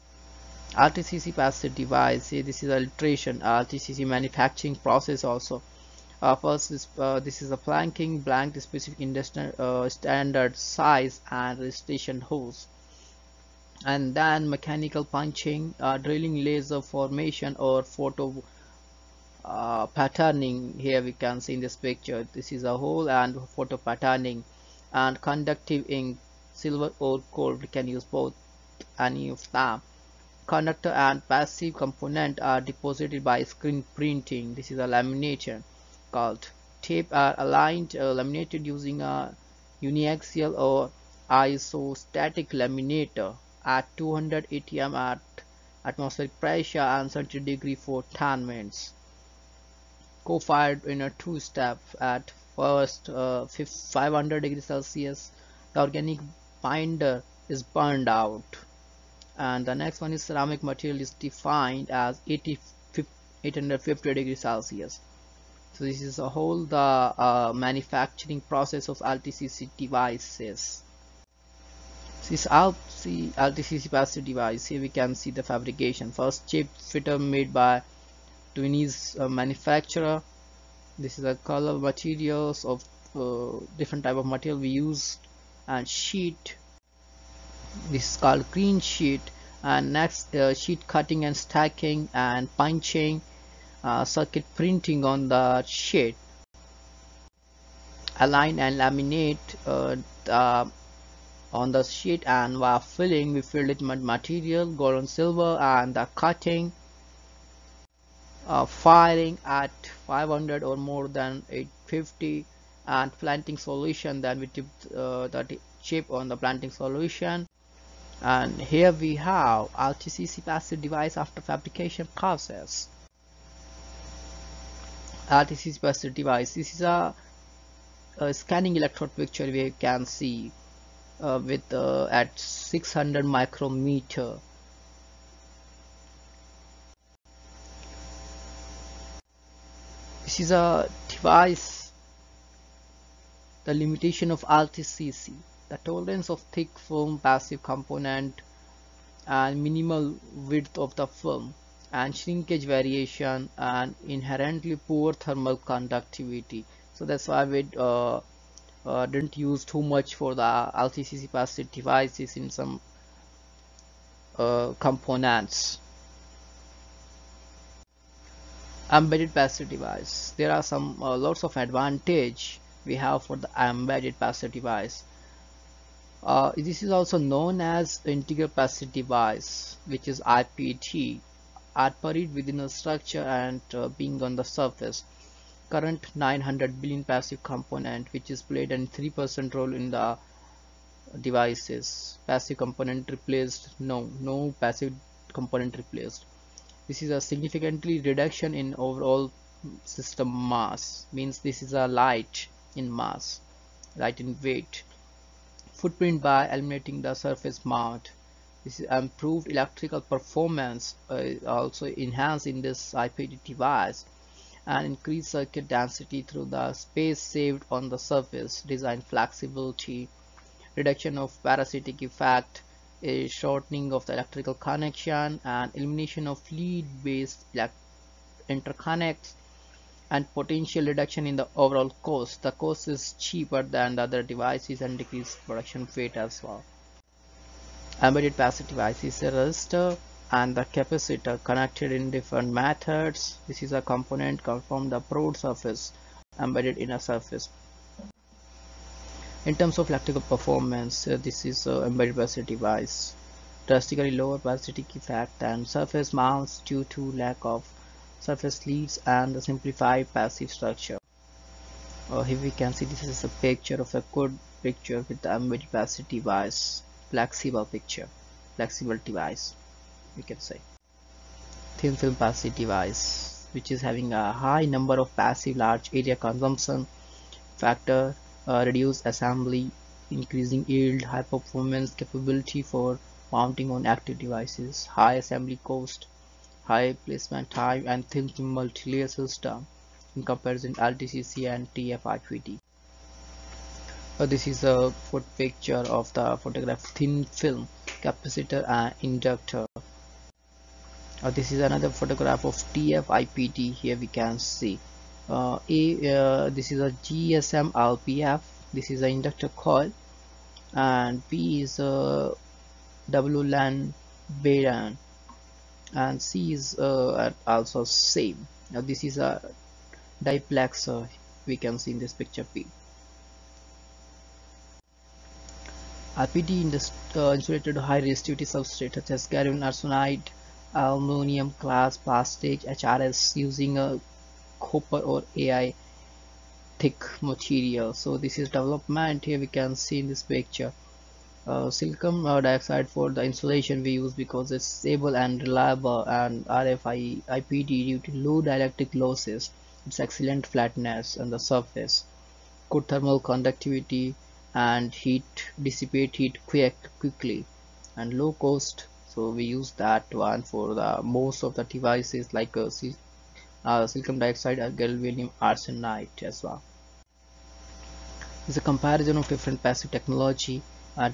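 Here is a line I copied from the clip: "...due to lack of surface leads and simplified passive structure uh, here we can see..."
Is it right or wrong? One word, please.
right.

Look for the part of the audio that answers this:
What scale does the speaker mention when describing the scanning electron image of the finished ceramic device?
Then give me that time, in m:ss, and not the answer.
2:12.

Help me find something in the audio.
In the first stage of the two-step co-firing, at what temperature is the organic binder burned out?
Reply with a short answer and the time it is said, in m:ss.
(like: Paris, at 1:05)
500 degrees Celsius, at 0:53.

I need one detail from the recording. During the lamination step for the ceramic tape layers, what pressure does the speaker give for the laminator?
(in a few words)
200 atm.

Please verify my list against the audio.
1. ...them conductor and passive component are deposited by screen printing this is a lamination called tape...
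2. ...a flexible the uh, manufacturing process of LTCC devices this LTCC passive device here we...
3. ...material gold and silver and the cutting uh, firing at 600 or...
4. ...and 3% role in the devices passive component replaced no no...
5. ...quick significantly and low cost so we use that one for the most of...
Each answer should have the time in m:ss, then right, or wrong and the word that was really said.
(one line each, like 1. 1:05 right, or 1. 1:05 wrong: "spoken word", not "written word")
1. 0:29 right
2. 1:06 wrong: "whole", not "flexible"
3. 1:44 wrong: "500", not "600"
4. 3:08 right
5. 5:56 wrong: "quickly", not "significantly".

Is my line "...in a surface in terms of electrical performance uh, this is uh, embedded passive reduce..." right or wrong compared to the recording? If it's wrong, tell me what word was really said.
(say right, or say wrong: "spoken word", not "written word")
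wrong: "device", not "reduce".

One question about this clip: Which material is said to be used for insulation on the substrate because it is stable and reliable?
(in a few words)
silicon dioxide.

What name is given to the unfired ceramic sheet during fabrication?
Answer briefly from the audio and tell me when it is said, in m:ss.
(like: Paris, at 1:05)
green sheet, at 1:28.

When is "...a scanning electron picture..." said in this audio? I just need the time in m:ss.
2:08.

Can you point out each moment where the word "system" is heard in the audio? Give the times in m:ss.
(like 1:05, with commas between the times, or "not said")
3:19, 4:49.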